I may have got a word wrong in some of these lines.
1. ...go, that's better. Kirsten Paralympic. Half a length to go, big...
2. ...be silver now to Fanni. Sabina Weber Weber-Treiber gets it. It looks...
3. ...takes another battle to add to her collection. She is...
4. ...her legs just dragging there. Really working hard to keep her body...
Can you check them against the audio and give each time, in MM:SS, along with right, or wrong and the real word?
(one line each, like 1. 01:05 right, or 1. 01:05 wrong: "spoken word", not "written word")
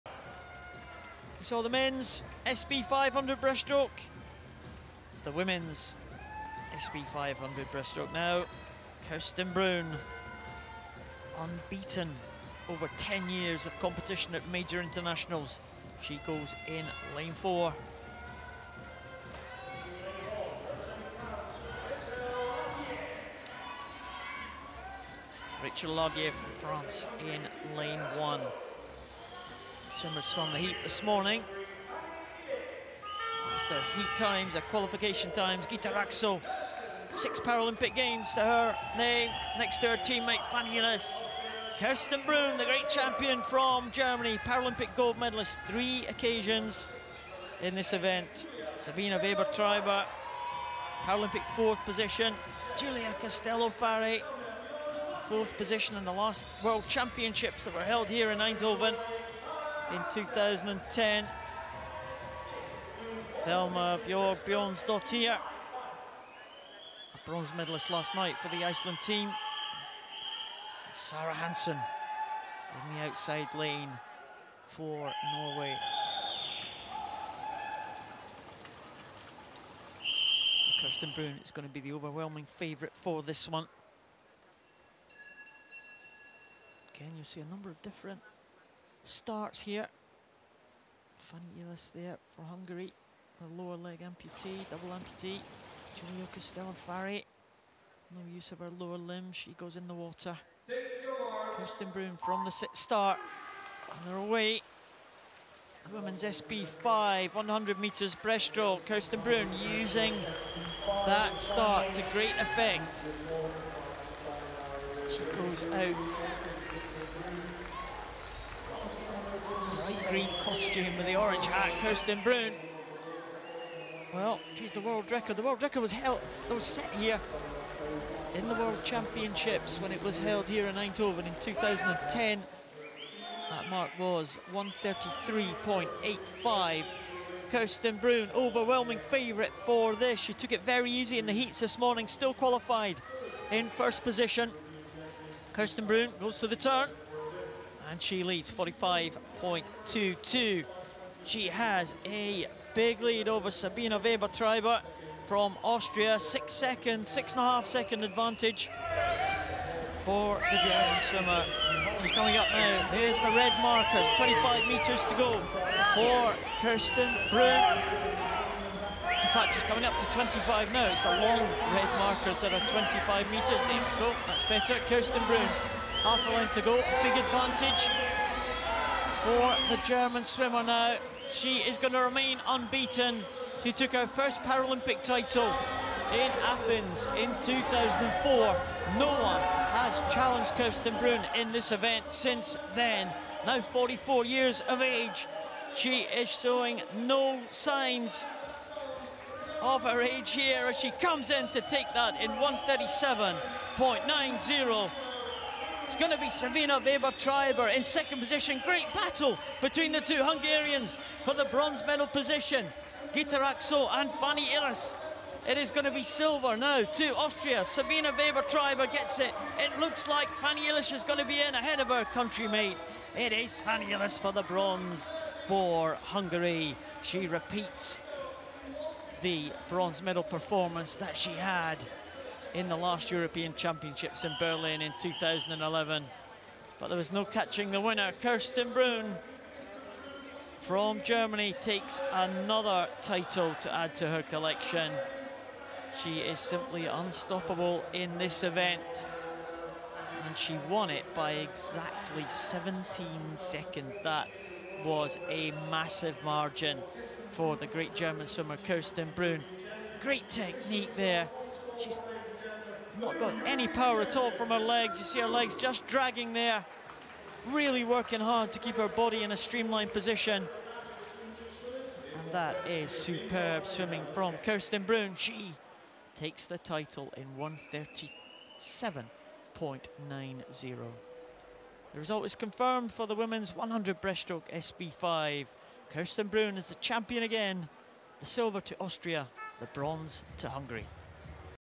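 1. 02:53 wrong: "Bruhn", not "Paralympic"
2. 03:35 wrong: "Austria", not "Fanni"
3. 04:01 wrong: "title", not "battle"
4. 04:25 right.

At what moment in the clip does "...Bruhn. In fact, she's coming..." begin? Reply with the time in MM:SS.
02:47.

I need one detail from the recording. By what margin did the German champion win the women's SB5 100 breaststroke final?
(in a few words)
17 seconds.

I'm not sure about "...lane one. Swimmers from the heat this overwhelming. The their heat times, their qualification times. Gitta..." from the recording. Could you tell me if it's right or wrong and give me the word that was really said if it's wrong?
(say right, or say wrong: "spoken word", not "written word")
wrong: "morning", not "overwhelming".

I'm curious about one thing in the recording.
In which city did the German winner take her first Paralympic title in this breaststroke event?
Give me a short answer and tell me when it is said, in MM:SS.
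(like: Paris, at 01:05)
Athens, at 03:06.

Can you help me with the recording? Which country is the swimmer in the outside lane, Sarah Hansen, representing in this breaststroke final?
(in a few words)
Norway.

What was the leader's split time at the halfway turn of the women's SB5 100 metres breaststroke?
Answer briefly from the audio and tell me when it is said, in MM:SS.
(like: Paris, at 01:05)
45.22, at 02:28.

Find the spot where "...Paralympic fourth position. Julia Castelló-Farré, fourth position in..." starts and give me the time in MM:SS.
00:51.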